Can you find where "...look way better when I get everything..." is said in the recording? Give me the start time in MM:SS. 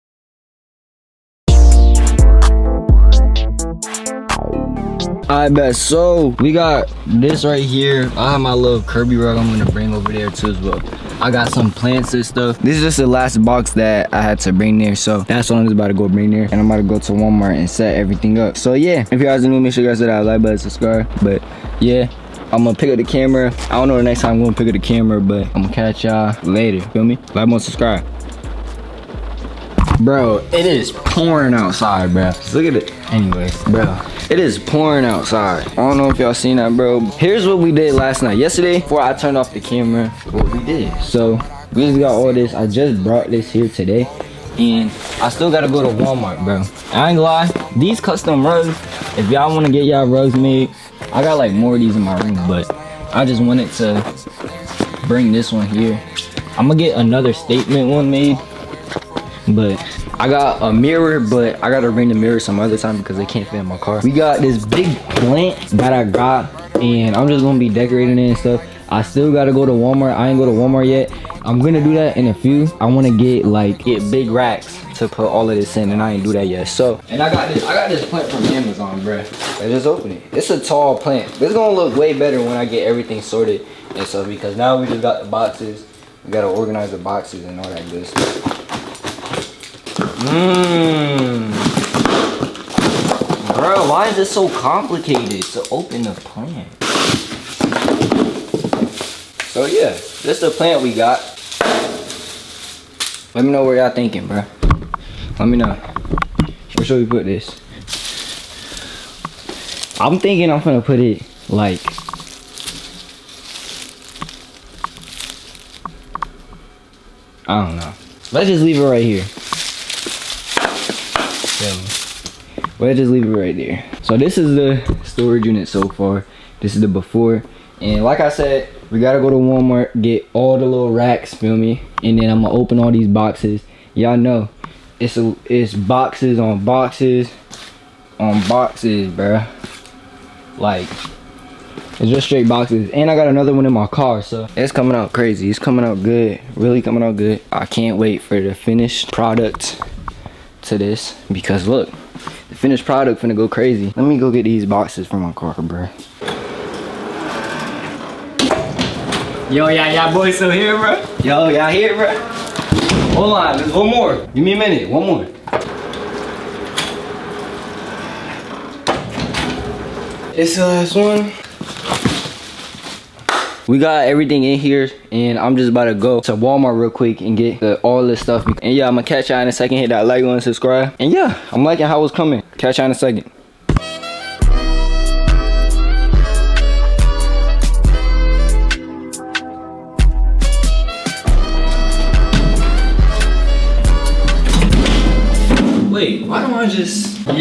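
01:21.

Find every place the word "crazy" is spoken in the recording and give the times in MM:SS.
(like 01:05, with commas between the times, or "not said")
02:25, 02:33.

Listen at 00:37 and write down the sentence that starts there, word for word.
Here's what we did last night.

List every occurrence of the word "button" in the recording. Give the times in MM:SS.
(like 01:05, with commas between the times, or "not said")
00:20, 03:00.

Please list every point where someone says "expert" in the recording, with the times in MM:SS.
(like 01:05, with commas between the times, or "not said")
not said.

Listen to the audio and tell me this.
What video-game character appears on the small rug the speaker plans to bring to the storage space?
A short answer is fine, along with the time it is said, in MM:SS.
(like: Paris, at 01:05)
Kirby, at 00:08.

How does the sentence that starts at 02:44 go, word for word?
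Give me a minute, one more.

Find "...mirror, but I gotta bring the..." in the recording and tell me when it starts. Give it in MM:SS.
01:00.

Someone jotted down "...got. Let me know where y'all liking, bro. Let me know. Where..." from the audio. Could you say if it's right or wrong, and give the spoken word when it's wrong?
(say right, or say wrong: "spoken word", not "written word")
wrong: "thinking", not "liking".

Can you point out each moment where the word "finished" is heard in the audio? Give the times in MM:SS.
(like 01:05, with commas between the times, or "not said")
02:28, 02:32.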